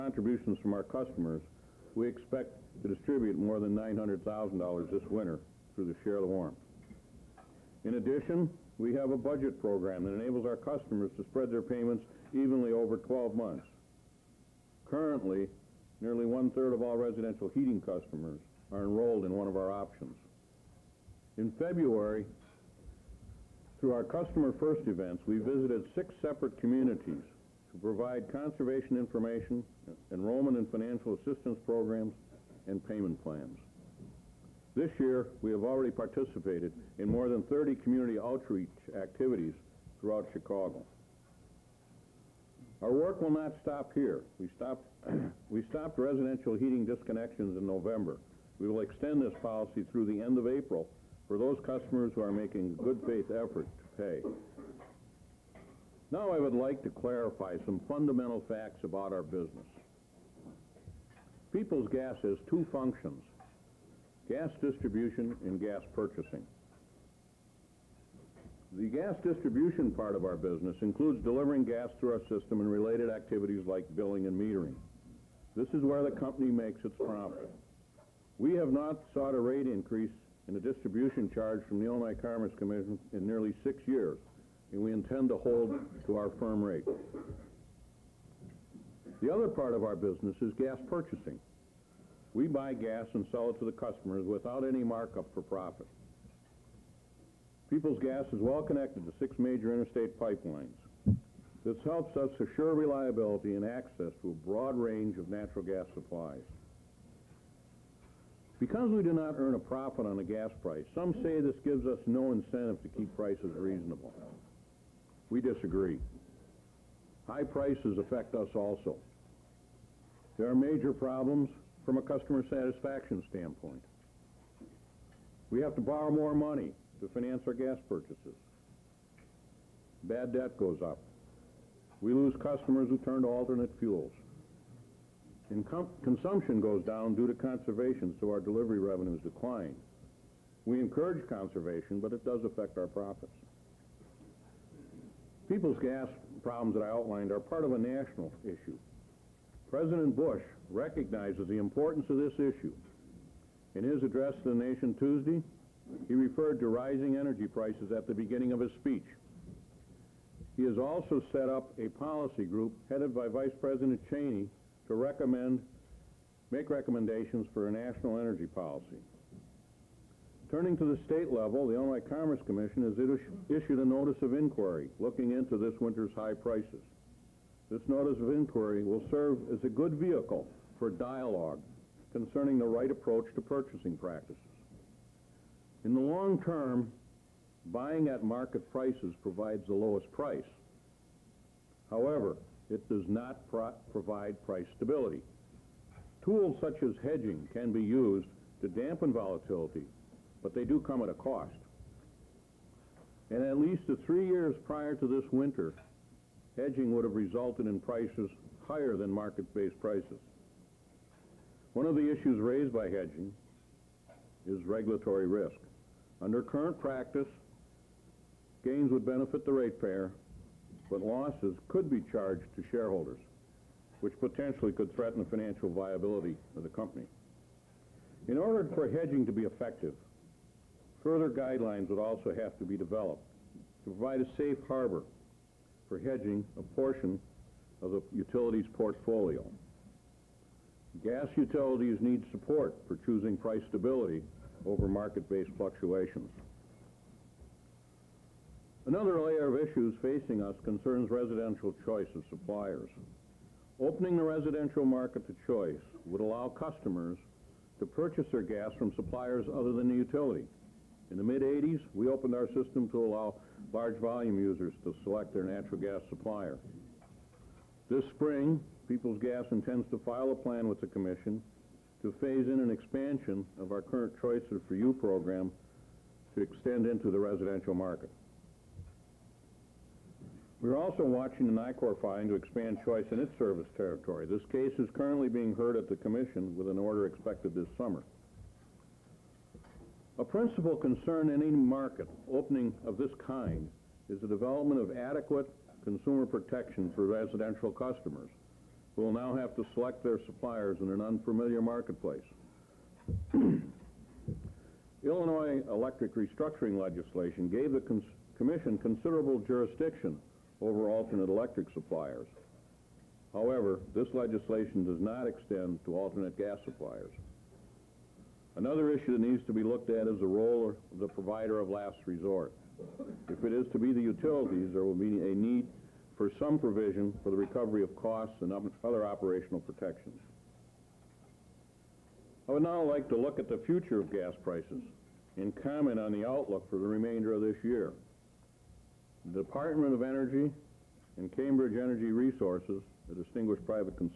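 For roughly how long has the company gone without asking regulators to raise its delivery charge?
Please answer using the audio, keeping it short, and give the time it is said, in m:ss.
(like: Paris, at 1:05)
nearly 6 years, at 1:23.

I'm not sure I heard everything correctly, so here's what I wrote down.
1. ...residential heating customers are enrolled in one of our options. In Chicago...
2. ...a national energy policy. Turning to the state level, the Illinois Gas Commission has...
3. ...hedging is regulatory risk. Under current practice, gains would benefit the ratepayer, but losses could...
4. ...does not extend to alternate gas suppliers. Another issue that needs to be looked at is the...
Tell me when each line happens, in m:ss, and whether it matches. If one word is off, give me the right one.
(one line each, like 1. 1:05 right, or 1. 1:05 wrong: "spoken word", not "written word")
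1. 0:16 wrong: "February", not "Chicago"
2. 2:47 wrong: "Commerce", not "Gas"
3. 3:32 right
4. 5:14 right.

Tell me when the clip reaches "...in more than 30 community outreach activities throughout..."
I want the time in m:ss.
0:36.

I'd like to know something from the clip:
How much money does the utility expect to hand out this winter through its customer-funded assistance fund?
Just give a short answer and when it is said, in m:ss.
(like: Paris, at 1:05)
more than $900,000, at 0:03.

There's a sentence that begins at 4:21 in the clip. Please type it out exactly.
In the mid-80s, we opened our system to allow large volume users to select their natural gas supplier.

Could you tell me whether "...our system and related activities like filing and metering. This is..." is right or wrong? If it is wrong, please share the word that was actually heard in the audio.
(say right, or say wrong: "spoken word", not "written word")
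wrong: "billing", not "filing".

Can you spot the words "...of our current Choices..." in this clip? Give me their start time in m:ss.
4:33.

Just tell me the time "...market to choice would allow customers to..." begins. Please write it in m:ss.
4:14.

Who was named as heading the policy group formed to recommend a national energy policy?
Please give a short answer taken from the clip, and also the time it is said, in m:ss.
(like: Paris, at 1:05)
Vice President Cheney, at 2:43.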